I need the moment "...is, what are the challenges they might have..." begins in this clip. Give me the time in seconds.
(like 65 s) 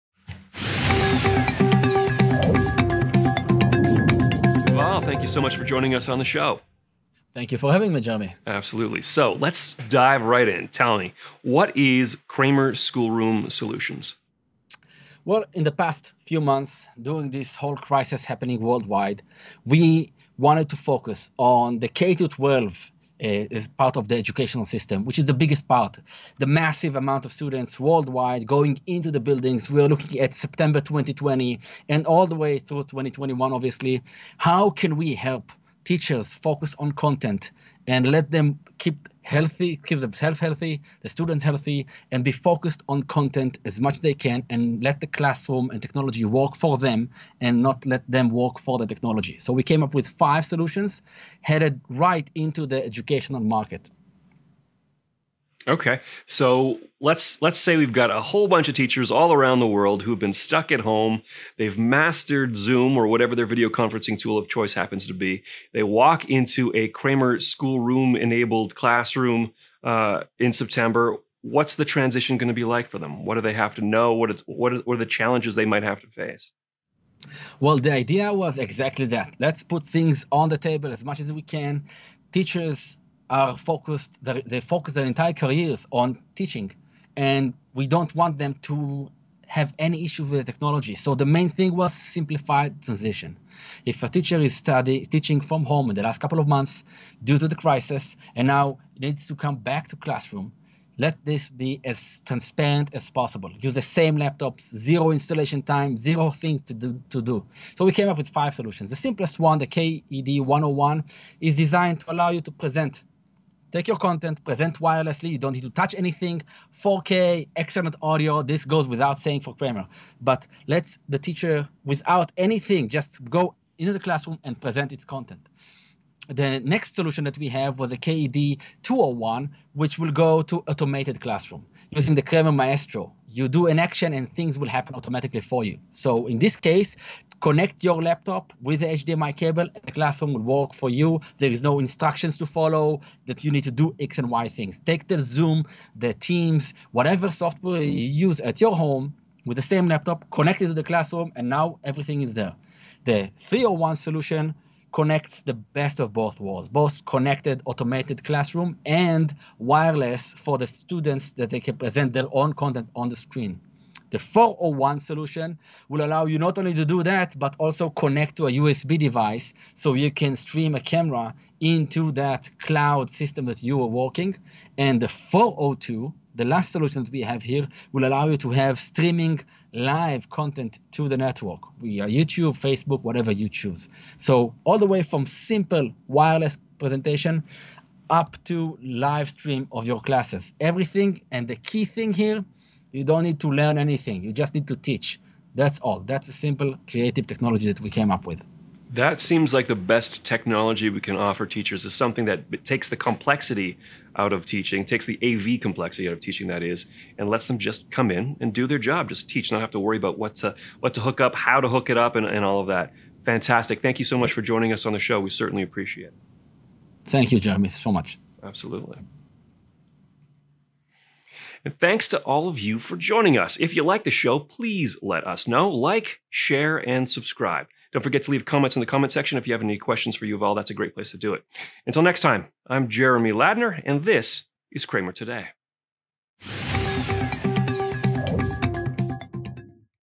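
74 s.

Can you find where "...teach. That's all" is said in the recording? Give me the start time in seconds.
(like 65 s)
194 s.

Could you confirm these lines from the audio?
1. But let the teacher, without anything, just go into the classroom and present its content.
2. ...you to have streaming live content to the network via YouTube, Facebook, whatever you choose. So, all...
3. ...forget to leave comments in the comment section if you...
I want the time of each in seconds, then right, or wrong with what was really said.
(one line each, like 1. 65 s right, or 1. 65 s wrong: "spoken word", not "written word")
1. 120 s right
2. 178 s right
3. 228 s right.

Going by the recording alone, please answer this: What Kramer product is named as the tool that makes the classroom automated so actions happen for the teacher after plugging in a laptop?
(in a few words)
Kramer Maestro.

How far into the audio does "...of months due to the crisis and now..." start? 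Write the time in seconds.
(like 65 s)
96 s.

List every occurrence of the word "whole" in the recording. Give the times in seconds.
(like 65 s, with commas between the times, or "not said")
17 s, 58 s.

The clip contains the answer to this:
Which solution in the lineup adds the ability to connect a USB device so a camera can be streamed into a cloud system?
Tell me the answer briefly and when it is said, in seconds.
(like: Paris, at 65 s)
401, at 164 s.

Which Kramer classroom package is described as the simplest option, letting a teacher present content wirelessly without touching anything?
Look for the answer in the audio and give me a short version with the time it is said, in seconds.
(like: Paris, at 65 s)
KED 101, at 109 s.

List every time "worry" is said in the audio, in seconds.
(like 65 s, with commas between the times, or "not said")
209 s.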